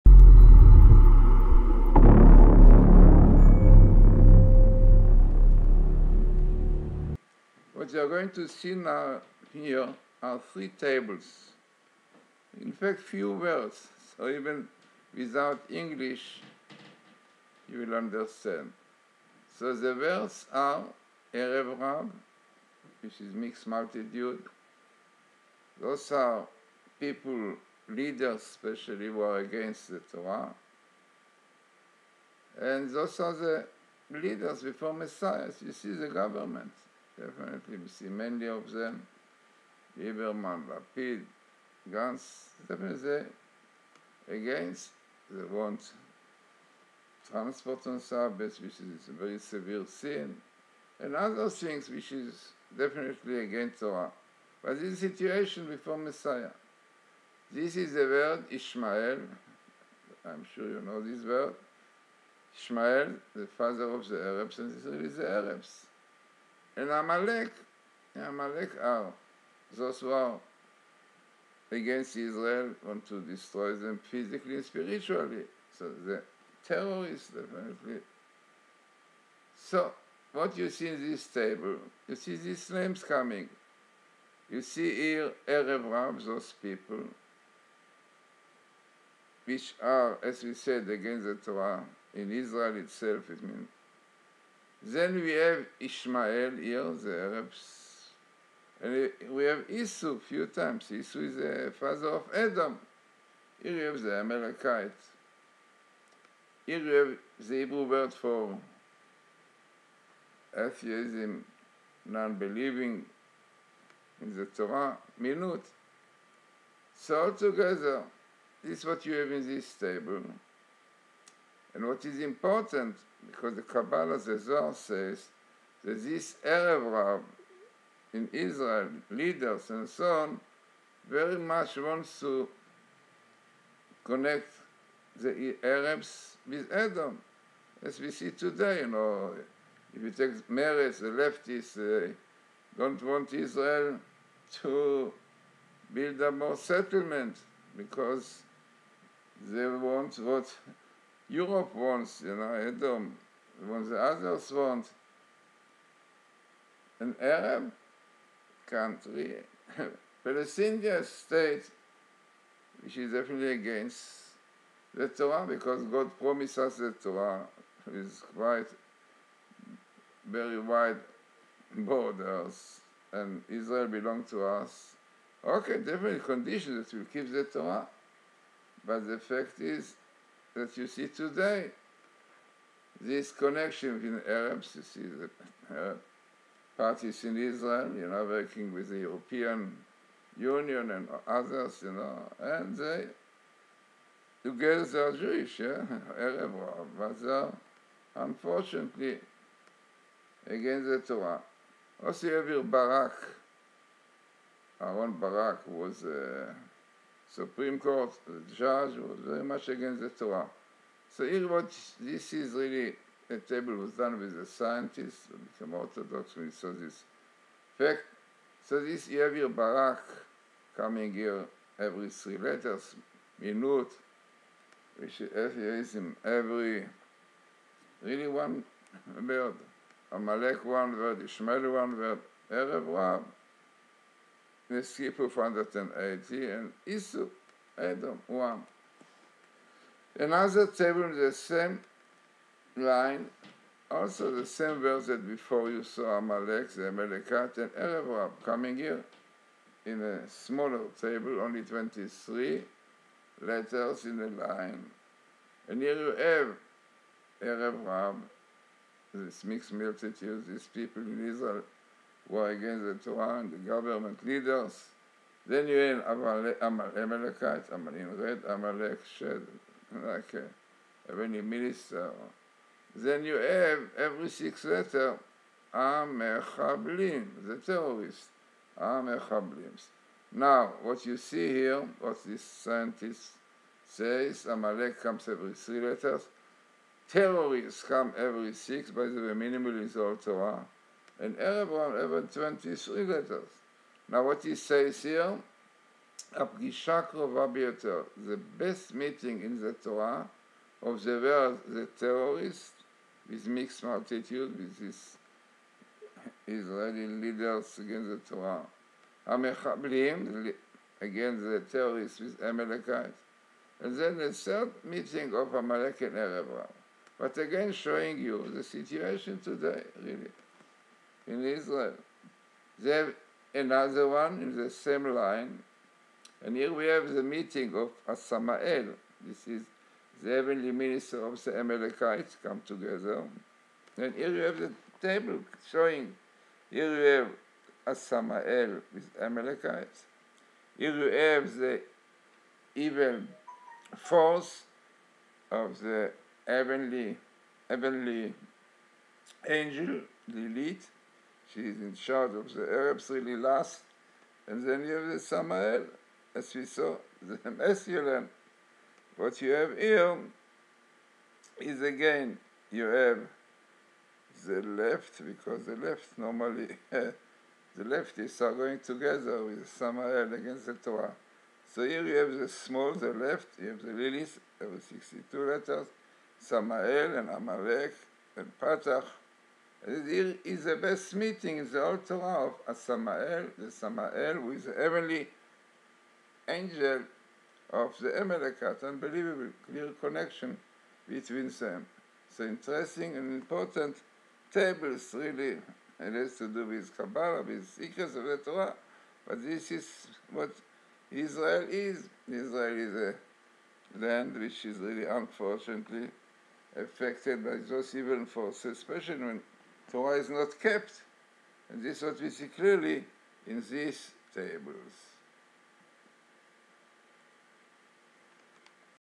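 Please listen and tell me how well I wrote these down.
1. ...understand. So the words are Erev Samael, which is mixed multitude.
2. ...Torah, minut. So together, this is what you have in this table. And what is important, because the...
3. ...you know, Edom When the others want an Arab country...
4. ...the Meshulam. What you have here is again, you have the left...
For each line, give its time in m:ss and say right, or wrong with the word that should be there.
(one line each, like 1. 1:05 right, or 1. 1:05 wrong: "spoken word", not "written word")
1. 0:17 wrong: "Rav", not "Samael"
2. 1:54 right
3. 2:32 right
4. 5:57 right.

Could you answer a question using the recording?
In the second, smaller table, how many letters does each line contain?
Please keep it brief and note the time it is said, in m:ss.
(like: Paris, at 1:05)
23, at 4:11.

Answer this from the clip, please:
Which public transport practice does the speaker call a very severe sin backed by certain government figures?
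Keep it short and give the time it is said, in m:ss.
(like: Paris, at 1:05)
Transport on Sabbath, at 0:47.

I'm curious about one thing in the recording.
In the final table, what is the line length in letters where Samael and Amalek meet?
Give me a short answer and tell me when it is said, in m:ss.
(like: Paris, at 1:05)
62, at 6:14.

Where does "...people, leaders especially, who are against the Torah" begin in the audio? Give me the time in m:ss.
0:26.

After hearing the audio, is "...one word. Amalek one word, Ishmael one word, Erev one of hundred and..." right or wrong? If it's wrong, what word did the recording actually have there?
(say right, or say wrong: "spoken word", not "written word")
right.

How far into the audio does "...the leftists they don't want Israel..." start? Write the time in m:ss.
2:20.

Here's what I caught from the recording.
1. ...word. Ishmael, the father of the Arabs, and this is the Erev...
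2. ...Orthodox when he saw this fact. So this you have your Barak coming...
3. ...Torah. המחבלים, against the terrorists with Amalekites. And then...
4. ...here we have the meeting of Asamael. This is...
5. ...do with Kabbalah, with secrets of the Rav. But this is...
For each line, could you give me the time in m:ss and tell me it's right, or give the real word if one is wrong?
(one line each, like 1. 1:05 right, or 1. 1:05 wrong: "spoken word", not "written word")
1. 1:01 wrong: "Arabs", not "Erev"
2. 3:35 right
3. 5:08 right
4. 5:26 right
5. 6:36 wrong: "Torah", not "Rav".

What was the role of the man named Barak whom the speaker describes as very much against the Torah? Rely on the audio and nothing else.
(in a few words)
Supreme Court judge.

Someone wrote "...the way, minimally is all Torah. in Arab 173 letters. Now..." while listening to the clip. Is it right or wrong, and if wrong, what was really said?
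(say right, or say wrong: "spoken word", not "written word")
wrong: "123", not "173".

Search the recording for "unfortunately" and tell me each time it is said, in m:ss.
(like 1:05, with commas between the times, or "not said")
3:18, 6:45.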